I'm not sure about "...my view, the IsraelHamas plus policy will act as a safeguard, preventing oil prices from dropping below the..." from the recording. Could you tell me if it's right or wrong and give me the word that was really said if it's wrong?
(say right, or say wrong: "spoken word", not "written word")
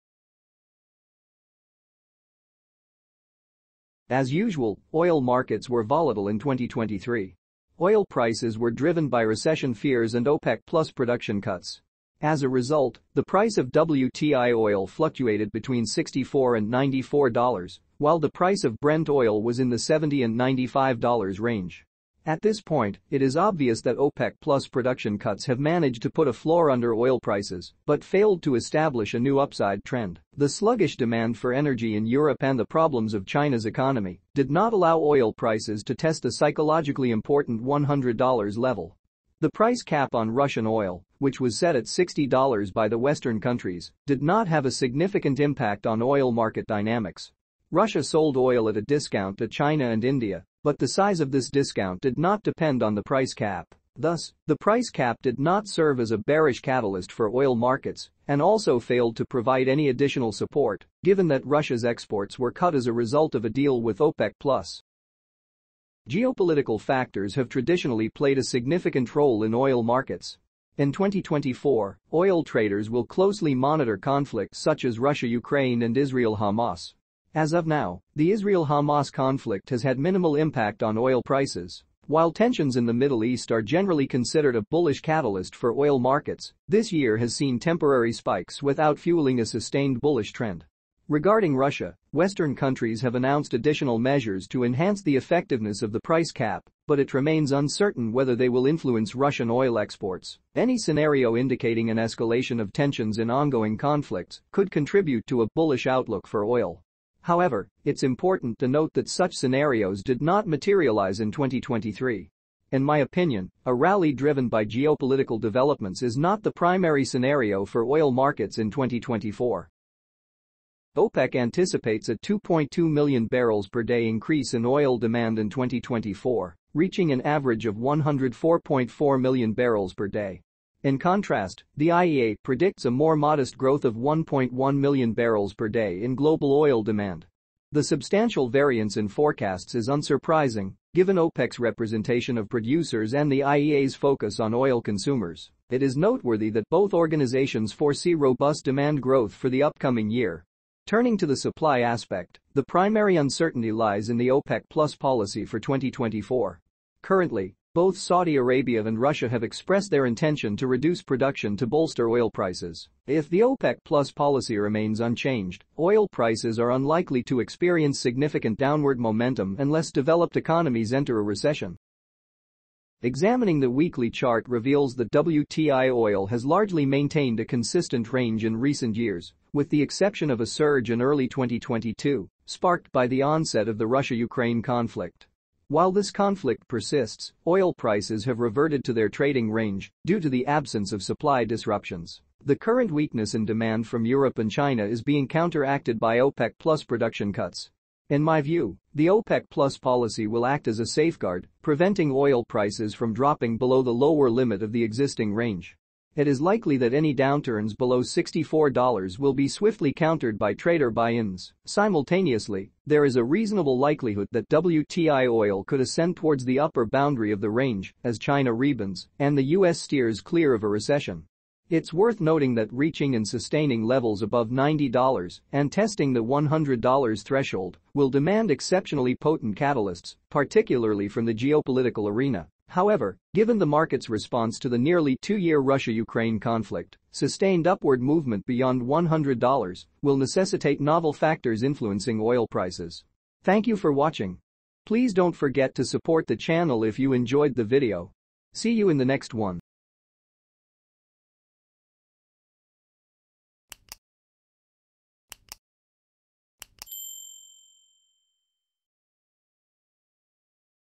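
wrong: "OPEC", not "IsraelHamas".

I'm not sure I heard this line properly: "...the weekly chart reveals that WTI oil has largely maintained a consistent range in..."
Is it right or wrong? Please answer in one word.
right.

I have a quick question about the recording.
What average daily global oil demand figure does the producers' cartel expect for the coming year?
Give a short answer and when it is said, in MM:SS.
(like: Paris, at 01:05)
104.4 million barrels per day, at 02:07.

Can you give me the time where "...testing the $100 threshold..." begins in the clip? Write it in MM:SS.
03:45.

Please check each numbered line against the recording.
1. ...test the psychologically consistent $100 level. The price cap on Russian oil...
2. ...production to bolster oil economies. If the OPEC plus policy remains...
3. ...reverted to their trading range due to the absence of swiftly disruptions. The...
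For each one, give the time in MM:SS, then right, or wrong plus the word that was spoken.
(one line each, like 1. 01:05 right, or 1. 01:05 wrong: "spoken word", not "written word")
1. 00:35 wrong: "important", not "consistent"
2. 02:41 wrong: "prices", not "economies"
3. 03:08 wrong: "supply", not "swiftly".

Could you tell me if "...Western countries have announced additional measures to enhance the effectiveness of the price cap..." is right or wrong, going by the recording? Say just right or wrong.
right.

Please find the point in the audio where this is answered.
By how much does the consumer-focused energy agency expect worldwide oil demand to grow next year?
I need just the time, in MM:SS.
02:13.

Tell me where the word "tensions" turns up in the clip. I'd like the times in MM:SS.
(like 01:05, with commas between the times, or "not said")
01:22, 01:42.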